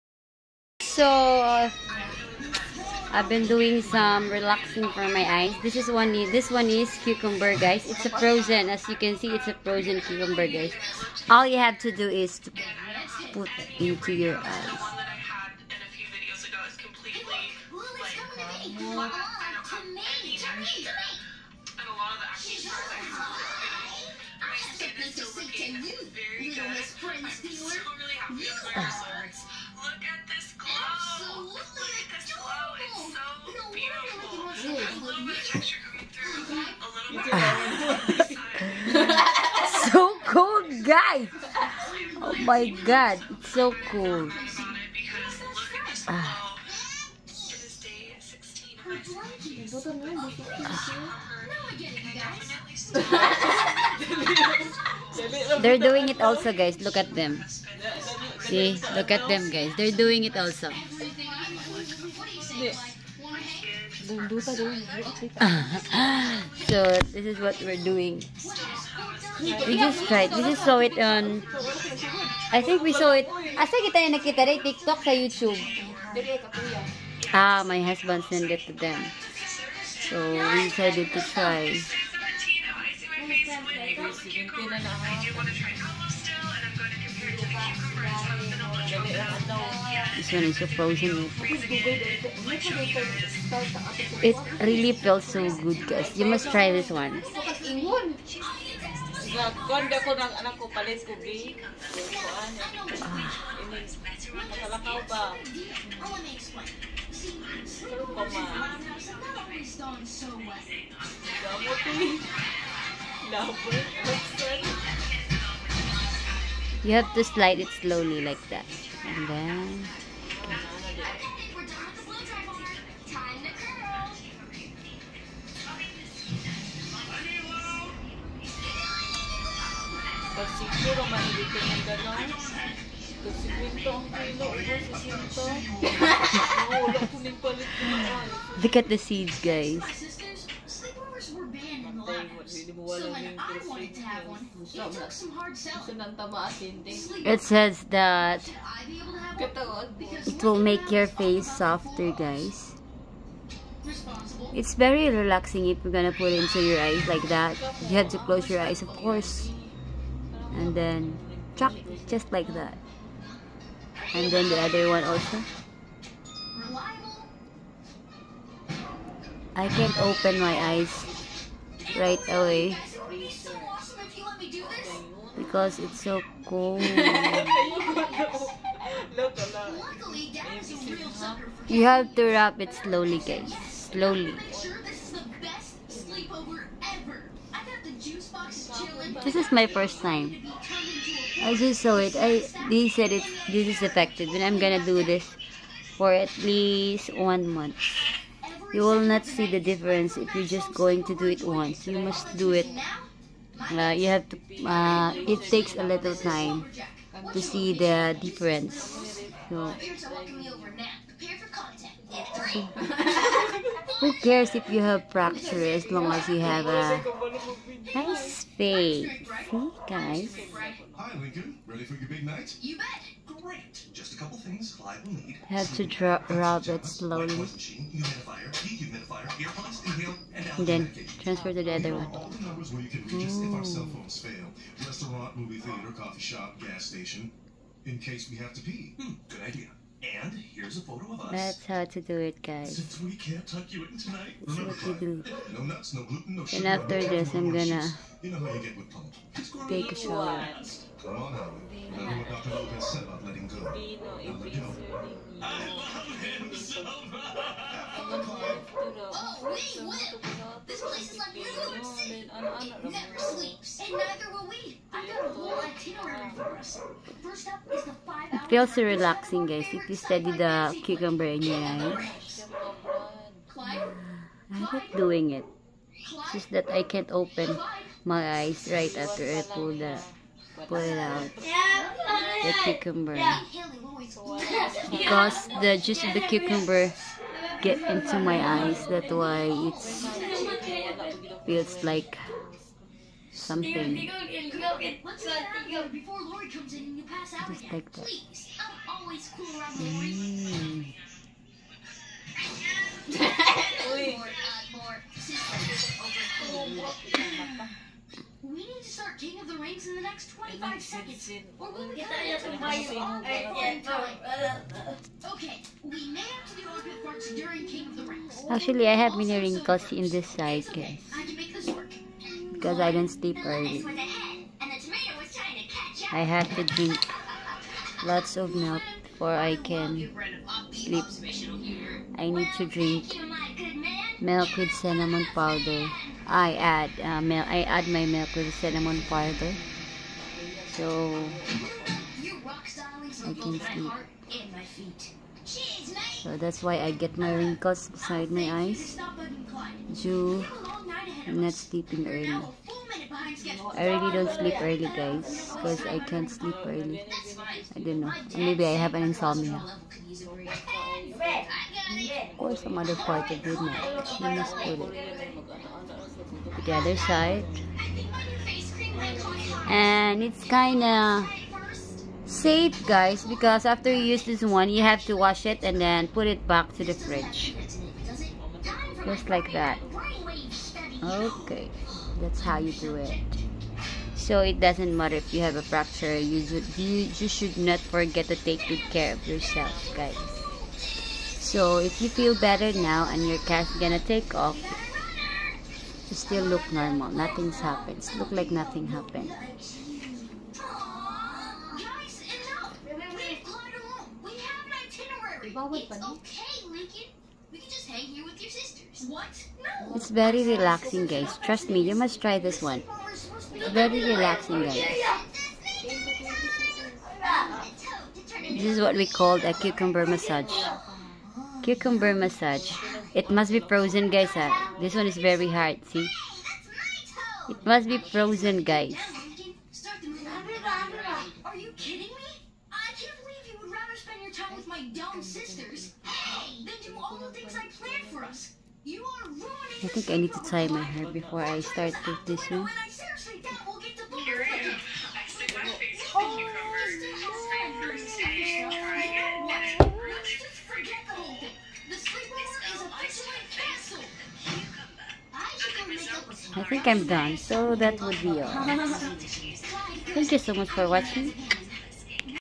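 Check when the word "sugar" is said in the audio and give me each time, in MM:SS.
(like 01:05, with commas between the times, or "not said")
04:06.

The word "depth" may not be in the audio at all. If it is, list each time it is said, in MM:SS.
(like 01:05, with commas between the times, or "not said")
not said.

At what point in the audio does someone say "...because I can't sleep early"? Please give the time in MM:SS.
05:55.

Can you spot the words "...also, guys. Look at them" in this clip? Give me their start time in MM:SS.
00:56.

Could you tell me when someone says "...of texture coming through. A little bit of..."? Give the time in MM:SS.
00:35.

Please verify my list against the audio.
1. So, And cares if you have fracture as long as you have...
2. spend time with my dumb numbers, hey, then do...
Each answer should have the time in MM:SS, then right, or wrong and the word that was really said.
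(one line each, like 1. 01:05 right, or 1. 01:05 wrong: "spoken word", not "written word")
1. 03:29 wrong: "Who", not "And"
2. 07:14 wrong: "sisters", not "numbers".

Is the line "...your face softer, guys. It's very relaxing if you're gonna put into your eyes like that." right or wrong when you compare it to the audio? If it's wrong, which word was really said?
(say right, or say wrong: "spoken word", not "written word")
right.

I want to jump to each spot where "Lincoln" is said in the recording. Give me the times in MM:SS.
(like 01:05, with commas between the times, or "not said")
03:41, 06:46.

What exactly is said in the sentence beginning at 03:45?
Have to drop, rub it slowly.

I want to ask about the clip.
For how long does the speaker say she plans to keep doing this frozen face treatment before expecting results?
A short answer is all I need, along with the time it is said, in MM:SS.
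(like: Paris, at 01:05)
1 month, at 03:17.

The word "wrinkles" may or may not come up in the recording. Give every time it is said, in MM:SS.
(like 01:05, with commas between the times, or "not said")
05:19, 05:47.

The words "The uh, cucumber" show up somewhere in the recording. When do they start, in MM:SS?
04:42.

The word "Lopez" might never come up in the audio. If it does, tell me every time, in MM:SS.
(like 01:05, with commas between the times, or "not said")
04:12.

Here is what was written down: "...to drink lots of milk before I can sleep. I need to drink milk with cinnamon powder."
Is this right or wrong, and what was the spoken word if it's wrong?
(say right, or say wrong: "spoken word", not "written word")
right.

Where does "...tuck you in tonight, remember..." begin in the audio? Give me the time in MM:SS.
04:03.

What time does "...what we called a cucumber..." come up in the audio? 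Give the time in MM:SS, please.
06:58.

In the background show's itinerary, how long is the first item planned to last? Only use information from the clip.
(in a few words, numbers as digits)
5 hours.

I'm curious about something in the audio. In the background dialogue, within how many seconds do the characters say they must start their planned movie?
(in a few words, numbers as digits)
25.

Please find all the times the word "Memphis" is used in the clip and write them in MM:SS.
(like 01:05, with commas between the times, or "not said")
not said.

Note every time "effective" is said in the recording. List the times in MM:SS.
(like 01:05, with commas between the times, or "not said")
03:13.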